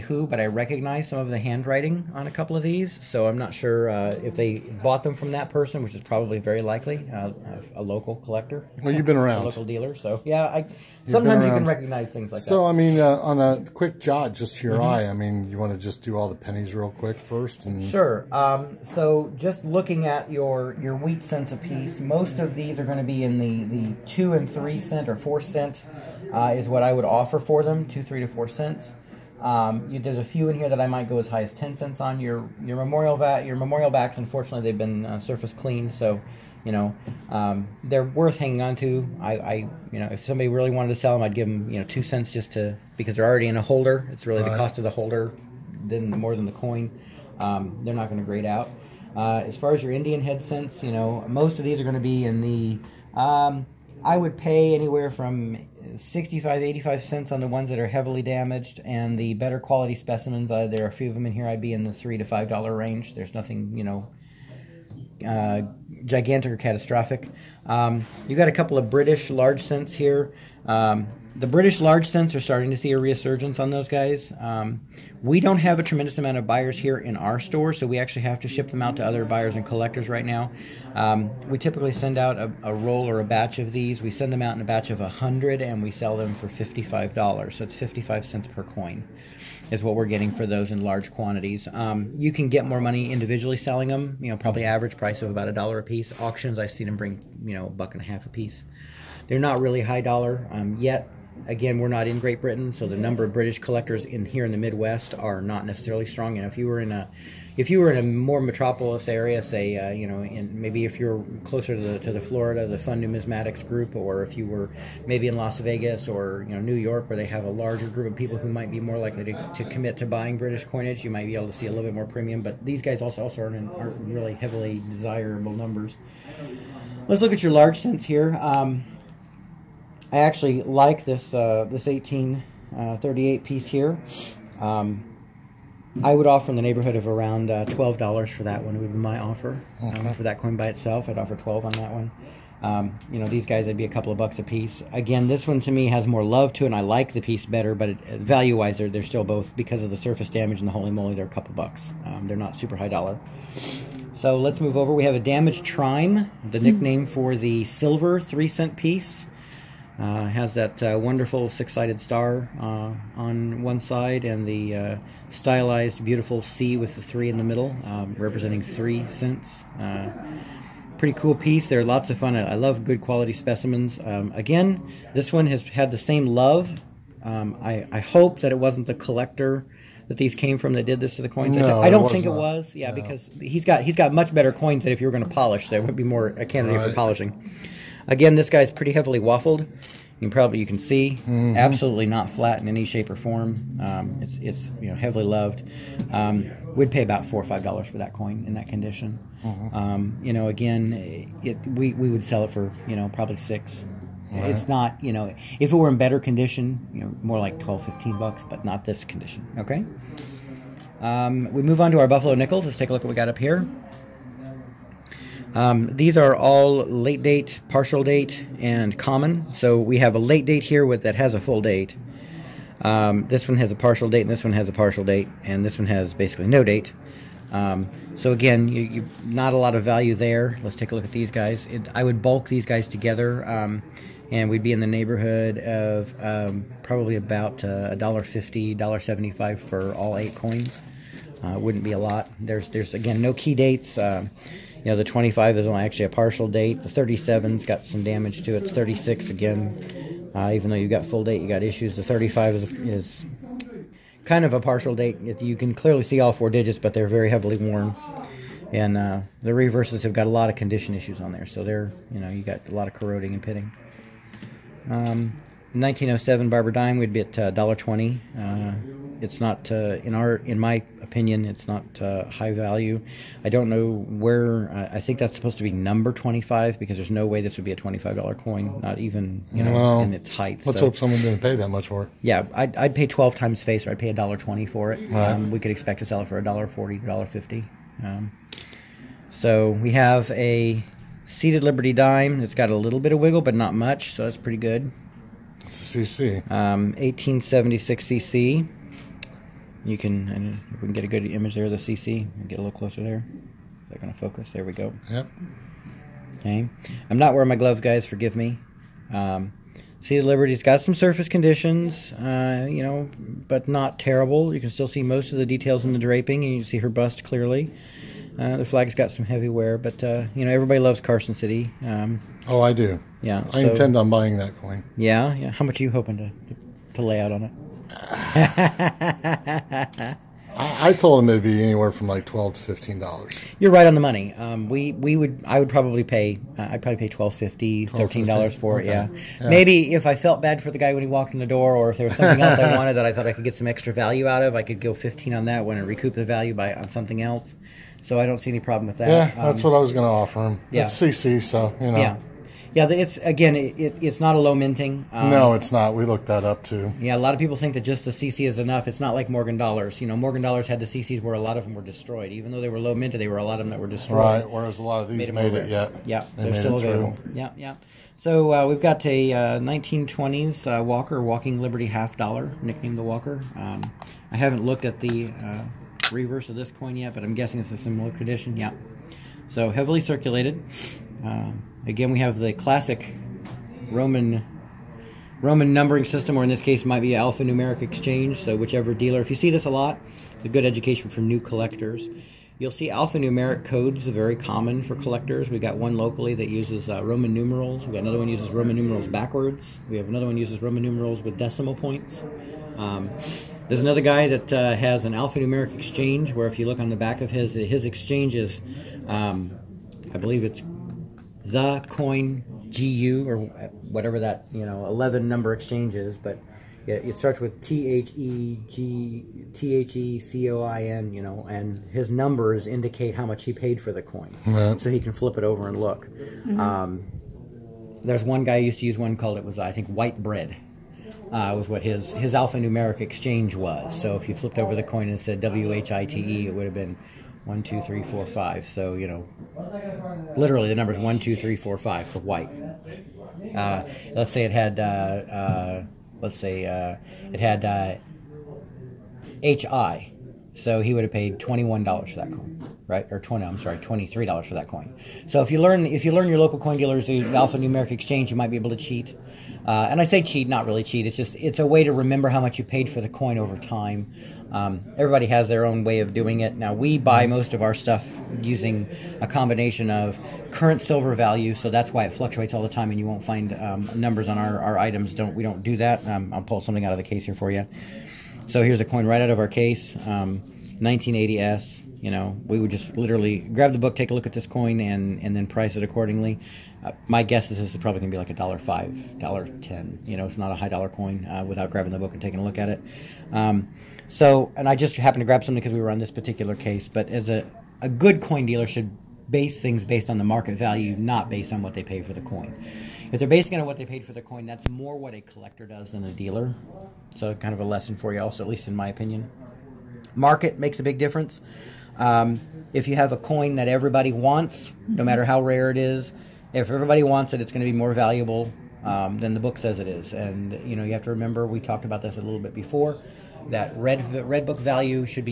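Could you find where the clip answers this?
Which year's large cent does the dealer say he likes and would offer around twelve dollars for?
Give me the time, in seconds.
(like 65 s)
131 s.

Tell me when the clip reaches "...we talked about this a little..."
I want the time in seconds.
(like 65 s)
521 s.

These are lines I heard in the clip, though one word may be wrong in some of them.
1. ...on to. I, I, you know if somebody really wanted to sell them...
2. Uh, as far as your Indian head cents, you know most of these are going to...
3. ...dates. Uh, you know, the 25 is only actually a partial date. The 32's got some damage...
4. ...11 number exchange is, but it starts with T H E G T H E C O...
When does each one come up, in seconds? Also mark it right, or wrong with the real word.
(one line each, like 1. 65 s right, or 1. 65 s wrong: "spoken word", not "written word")
1. 38 s right
2. 49 s right
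3. 243 s wrong: "37", not "32"
4. 414 s right.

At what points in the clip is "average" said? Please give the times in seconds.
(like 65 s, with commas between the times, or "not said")
94 s.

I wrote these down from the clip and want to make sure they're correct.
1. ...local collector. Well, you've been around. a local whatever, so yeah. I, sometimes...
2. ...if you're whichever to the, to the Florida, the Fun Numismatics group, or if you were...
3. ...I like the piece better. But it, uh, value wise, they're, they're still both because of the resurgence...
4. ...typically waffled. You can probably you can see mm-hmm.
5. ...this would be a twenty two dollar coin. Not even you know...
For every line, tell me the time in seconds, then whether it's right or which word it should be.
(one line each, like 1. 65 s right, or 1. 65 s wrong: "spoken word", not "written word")
1. 7 s wrong: "dealer", not "whatever"
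2. 110 s wrong: "closer", not "whichever"
3. 146 s wrong: "surface", not "resurgence"
4. 188 s wrong: "heavily", not "typically"
5. 277 s wrong: "five", not "two".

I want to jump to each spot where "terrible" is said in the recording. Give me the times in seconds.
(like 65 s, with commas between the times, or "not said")
313 s.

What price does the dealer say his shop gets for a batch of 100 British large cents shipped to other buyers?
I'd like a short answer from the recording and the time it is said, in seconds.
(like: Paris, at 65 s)
$55, at 85 s.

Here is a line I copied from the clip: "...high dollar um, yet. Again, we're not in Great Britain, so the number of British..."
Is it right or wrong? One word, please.
right.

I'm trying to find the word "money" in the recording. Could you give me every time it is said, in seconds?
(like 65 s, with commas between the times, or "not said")
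92 s, 334 s.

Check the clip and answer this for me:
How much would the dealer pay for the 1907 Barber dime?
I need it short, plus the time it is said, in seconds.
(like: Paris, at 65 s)
$1.20, at 267 s.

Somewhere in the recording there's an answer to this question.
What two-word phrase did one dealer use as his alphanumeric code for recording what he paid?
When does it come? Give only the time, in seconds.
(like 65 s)
429 s.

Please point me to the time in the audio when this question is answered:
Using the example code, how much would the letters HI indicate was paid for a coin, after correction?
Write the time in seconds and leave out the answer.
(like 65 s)
453 s.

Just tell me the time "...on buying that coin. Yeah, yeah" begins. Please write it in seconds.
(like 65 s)
323 s.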